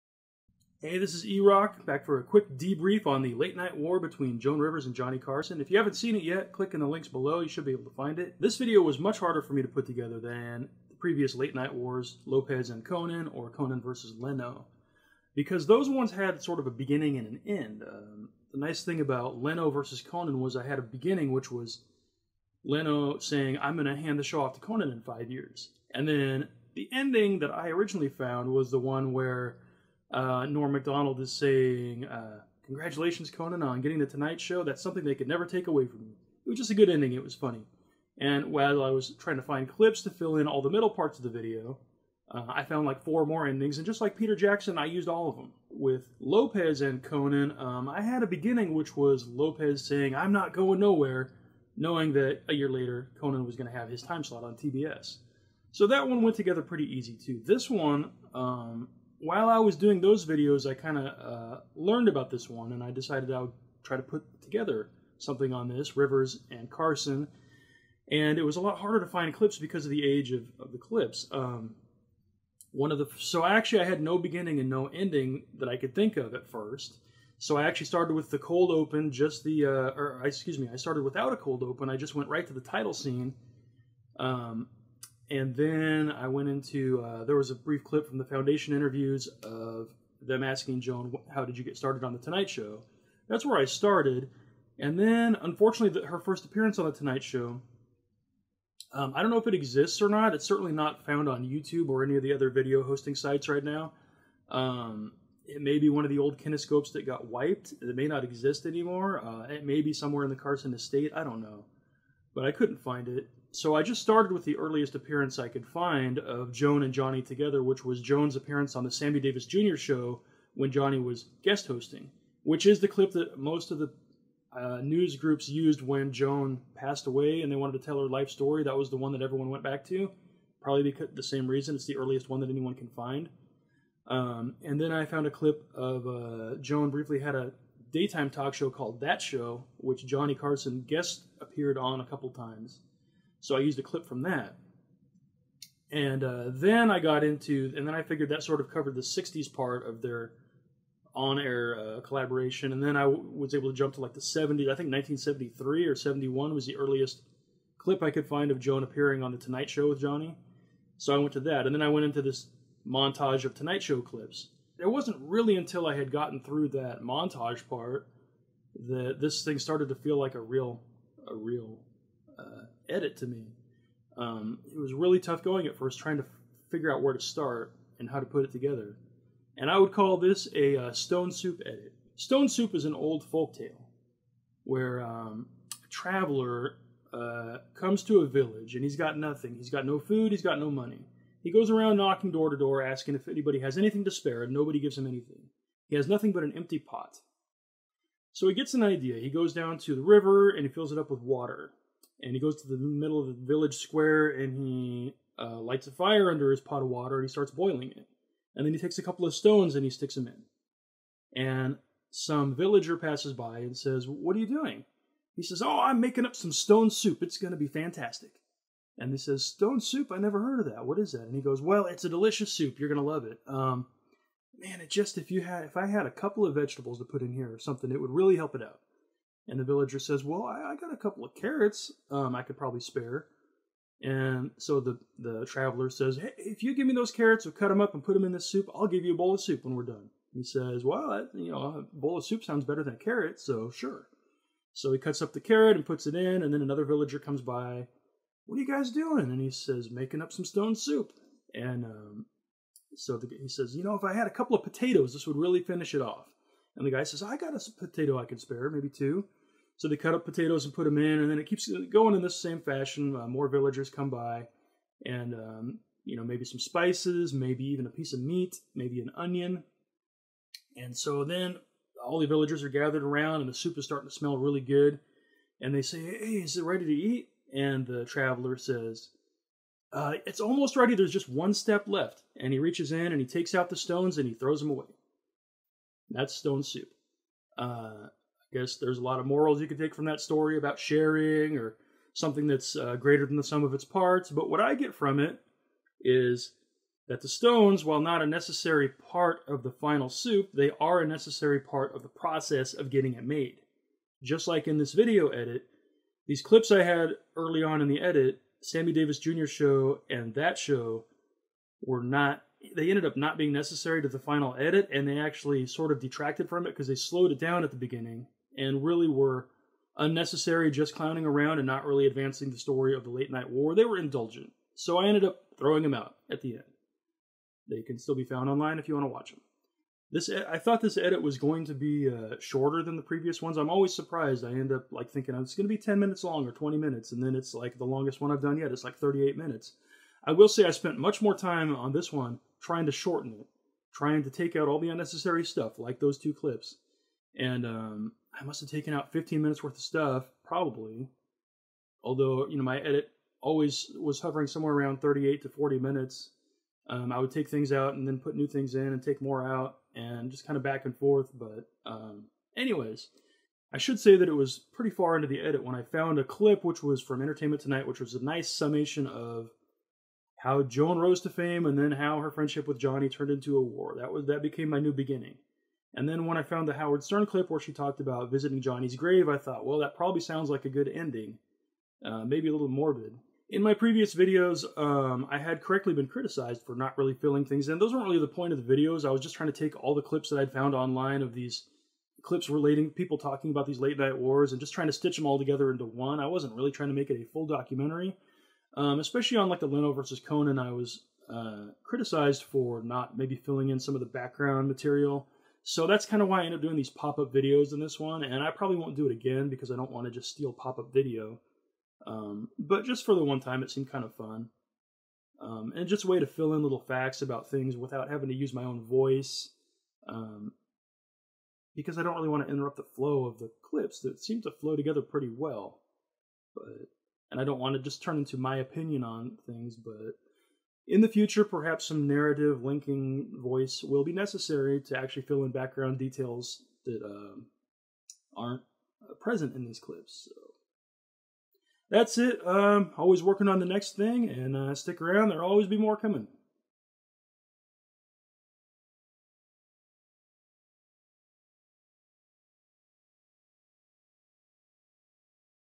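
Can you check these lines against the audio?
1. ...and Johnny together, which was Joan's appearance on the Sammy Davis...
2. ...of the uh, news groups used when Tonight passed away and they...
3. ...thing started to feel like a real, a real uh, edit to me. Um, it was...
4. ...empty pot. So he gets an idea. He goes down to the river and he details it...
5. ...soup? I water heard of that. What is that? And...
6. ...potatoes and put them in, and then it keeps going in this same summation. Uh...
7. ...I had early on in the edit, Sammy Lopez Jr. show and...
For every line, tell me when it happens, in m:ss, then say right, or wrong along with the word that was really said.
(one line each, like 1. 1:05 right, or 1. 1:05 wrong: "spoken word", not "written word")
1. 1:56 right
2. 2:03 wrong: "Joan", not "Tonight"
3. 2:49 right
4. 3:16 wrong: "fills", not "details"
5. 3:39 wrong: "never", not "water"
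6. 4:20 wrong: "fashion", not "summation"
7. 5:06 wrong: "Davis", not "Lopez".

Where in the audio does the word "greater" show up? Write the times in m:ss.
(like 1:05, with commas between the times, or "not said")
4:52.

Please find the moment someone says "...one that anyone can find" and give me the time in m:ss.
2:12.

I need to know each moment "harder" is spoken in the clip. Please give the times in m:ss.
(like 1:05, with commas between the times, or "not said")
0:09, 1:08.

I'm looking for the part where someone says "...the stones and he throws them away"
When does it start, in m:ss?
4:43.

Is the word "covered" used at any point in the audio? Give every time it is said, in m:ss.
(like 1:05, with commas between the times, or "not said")
2:28.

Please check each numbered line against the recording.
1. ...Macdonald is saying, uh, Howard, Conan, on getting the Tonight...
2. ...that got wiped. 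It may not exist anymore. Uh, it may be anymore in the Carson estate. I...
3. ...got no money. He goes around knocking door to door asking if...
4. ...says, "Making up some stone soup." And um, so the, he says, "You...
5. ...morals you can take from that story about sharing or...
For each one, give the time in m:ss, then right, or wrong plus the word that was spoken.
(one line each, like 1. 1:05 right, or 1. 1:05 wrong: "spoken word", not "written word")
1. 0:30 wrong: "Congratulations", not "Howard"
2. 1:46 wrong: "somewhere", not "anymore"
3. 3:10 right
4. 4:09 right
5. 4:49 right.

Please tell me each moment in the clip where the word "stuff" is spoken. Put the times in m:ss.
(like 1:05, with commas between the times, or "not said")
5:45, 5:49.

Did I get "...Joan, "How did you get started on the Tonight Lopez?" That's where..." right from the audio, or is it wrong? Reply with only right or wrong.
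wrong.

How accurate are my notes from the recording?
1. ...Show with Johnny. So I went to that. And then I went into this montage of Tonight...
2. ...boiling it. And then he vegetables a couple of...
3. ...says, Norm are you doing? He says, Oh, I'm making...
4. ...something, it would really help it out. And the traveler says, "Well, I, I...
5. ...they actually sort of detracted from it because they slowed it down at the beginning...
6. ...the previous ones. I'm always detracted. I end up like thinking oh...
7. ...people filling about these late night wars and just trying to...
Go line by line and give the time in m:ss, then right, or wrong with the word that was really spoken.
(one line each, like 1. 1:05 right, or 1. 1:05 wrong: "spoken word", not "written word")
1. 2:39 right
2. 3:27 wrong: "takes", not "vegetables"
3. 3:33 wrong: "What", not "Norm"
4. 3:47 wrong: "villager", not "traveler"
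5. 5:15 right
6. 5:32 wrong: "surprised", not "detracted"
7. 6:32 wrong: "talking", not "filling".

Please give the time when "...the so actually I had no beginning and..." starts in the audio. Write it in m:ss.
1:12.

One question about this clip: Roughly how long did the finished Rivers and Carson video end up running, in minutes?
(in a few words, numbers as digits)
38.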